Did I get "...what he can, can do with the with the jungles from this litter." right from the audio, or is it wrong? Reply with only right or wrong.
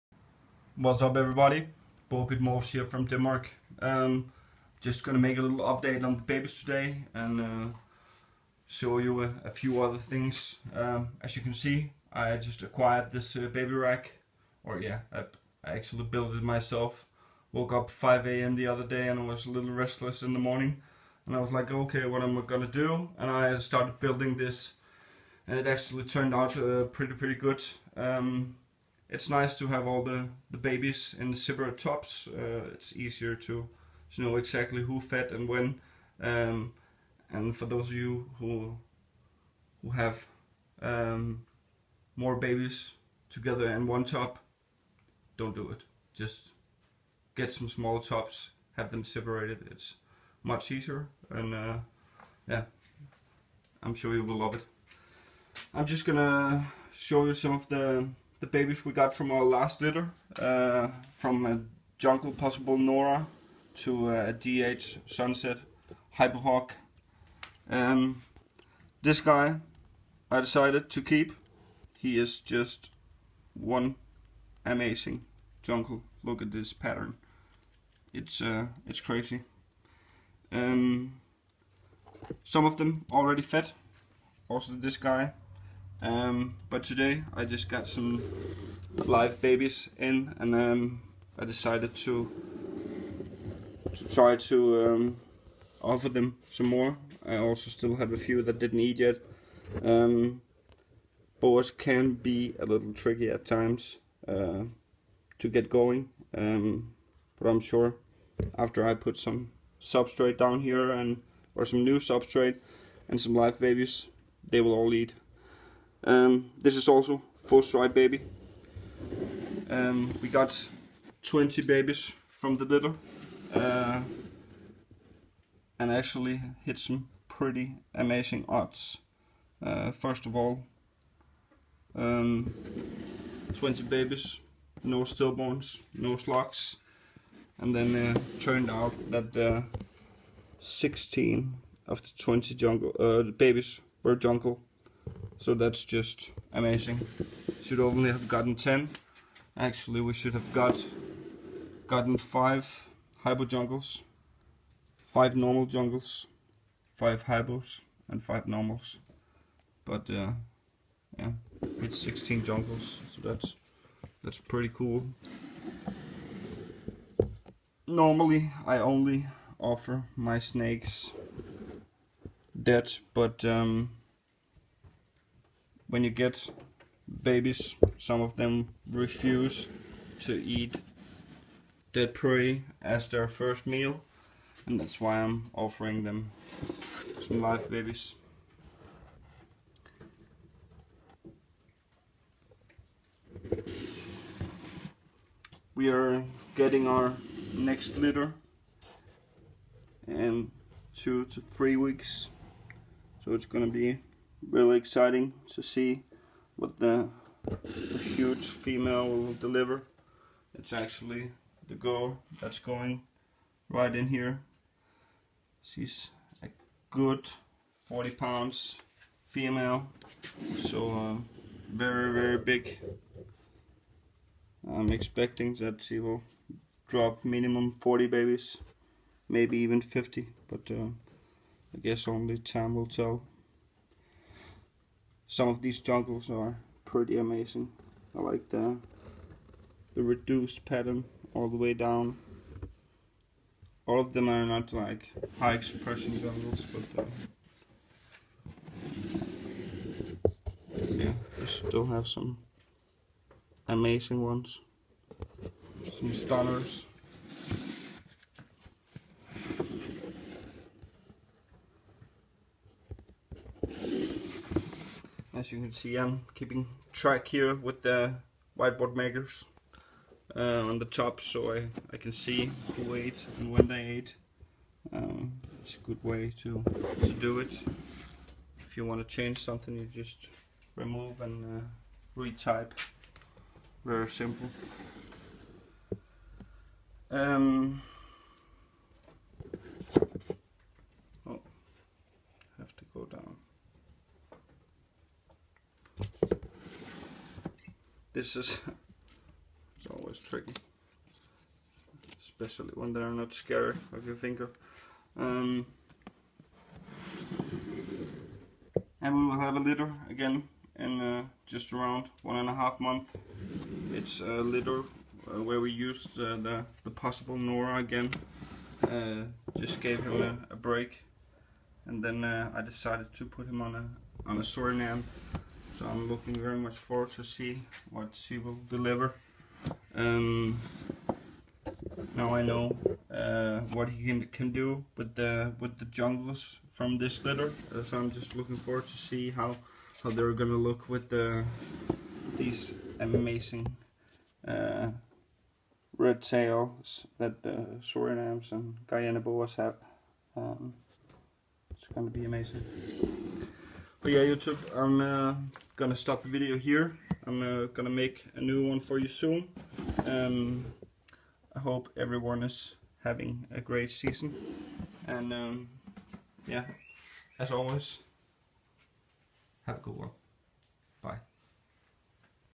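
right.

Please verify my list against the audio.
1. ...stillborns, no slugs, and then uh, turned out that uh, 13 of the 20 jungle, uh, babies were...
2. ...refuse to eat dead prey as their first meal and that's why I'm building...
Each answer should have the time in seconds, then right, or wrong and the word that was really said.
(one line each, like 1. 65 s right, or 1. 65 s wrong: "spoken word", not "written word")
1. 135 s wrong: "16", not "13"
2. 178 s wrong: "offering", not "building".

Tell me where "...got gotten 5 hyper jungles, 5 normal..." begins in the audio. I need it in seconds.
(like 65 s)
150 s.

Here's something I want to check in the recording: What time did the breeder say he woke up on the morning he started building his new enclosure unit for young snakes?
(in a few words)
5 a.m.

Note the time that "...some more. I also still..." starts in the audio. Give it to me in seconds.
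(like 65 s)
96 s.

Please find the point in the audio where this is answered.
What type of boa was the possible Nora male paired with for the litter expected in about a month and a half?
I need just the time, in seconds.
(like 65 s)
324 s.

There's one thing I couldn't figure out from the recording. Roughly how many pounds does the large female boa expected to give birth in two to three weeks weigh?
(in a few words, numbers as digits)
40.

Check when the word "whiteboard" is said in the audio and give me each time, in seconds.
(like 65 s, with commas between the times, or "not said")
268 s.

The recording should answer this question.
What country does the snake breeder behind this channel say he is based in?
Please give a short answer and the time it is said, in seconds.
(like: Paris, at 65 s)
Denmark, at 3 s.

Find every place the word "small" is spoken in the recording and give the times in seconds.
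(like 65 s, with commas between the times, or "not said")
47 s.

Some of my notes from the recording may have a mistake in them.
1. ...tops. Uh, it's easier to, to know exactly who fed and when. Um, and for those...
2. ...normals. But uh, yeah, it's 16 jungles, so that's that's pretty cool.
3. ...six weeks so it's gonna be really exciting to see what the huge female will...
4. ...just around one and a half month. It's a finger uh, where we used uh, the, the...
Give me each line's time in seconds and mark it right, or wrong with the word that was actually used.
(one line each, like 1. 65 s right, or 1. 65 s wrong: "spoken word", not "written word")
1. 31 s right
2. 158 s right
3. 201 s wrong: "three", not "six"
4. 311 s wrong: "litter", not "finger".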